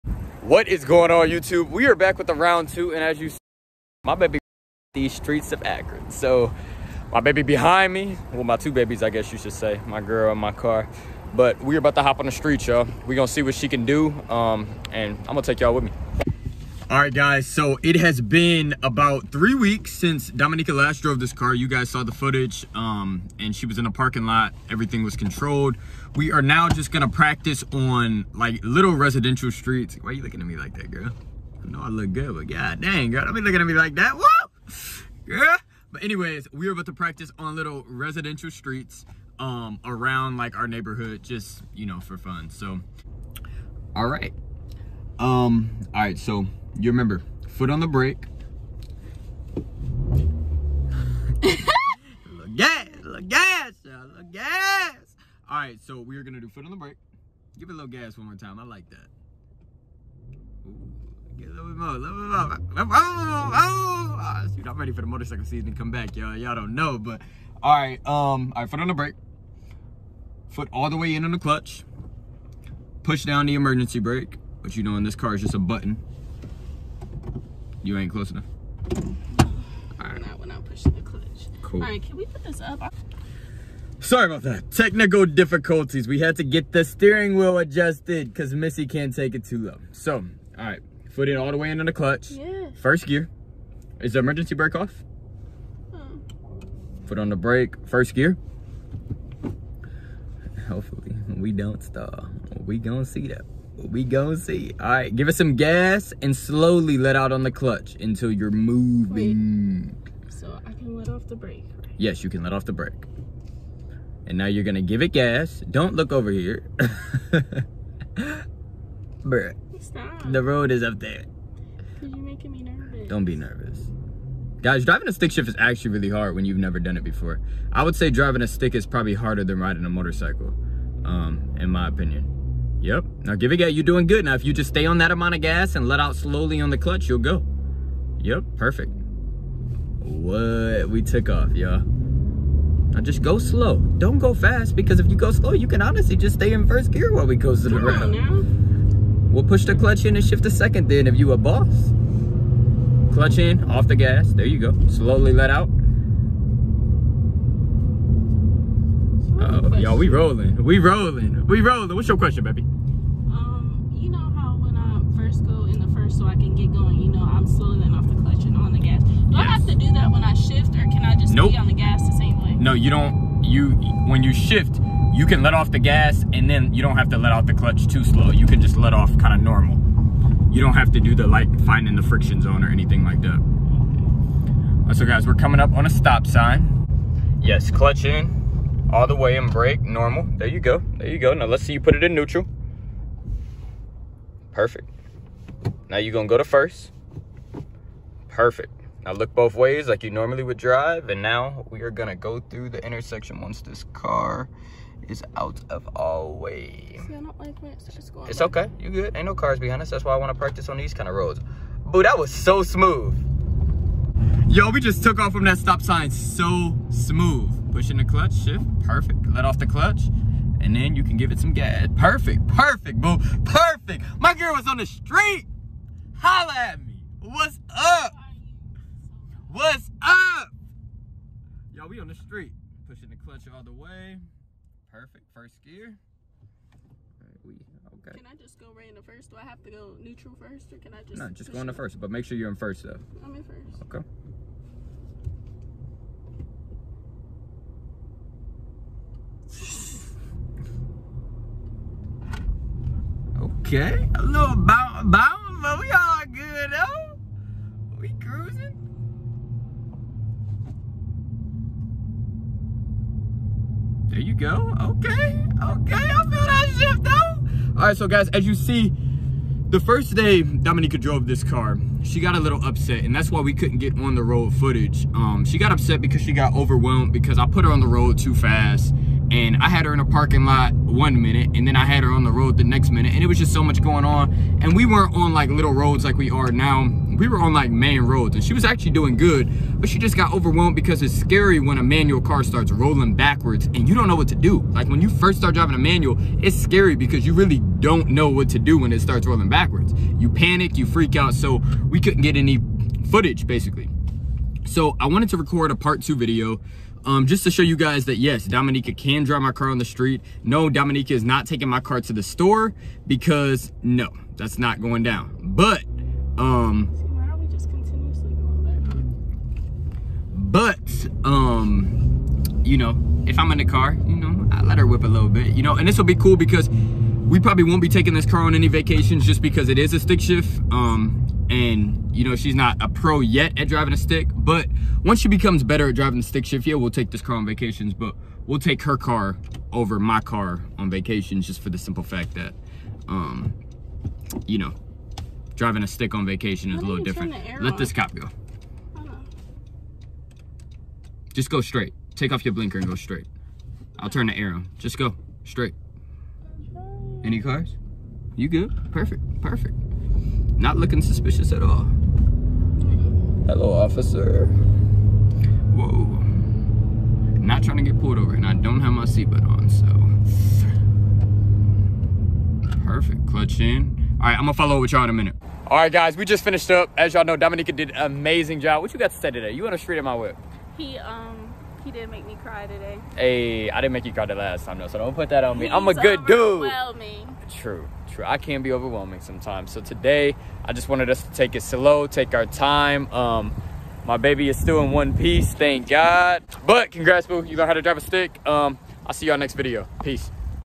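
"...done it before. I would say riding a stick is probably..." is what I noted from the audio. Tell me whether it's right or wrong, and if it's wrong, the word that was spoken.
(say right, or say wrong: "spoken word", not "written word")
wrong: "driving", not "riding".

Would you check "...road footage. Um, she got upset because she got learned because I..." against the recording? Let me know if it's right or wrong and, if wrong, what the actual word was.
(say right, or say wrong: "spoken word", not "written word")
wrong: "overwhelmed", not "learned".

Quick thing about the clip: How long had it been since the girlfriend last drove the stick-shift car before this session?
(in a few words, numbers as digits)
about three weeks.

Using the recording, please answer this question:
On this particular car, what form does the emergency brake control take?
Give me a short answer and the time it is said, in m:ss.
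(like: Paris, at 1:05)
a button, at 1:15.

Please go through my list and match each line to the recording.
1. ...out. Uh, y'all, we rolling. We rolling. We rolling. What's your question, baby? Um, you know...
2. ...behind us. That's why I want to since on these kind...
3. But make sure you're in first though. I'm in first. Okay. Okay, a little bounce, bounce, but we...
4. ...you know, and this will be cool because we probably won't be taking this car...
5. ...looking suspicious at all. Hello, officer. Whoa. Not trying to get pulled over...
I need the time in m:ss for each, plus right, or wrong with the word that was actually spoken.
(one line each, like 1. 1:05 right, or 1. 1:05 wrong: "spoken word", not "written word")
1. 2:35 right
2. 3:29 wrong: "practice", not "since"
3. 4:02 right
4. 5:25 right
5. 6:00 right.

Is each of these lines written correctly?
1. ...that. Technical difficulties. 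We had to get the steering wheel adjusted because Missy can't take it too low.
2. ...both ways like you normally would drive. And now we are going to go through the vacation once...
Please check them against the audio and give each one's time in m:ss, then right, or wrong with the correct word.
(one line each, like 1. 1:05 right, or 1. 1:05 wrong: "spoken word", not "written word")
1. 1:24 right
2. 3:19 wrong: "intersection", not "vacation".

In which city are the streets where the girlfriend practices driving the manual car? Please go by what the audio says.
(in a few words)
Akron.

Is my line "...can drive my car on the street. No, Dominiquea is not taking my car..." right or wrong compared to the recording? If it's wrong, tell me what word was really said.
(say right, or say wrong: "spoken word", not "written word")
right.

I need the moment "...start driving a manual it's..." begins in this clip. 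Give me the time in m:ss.
4:55.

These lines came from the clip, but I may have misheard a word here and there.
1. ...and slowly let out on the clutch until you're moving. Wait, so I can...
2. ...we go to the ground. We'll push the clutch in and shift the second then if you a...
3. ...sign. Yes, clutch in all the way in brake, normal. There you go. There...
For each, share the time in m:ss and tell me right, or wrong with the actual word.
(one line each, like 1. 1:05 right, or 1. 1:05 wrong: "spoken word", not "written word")
1. 1:46 right
2. 2:27 right
3. 3:06 right.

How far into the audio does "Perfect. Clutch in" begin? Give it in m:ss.
6:12.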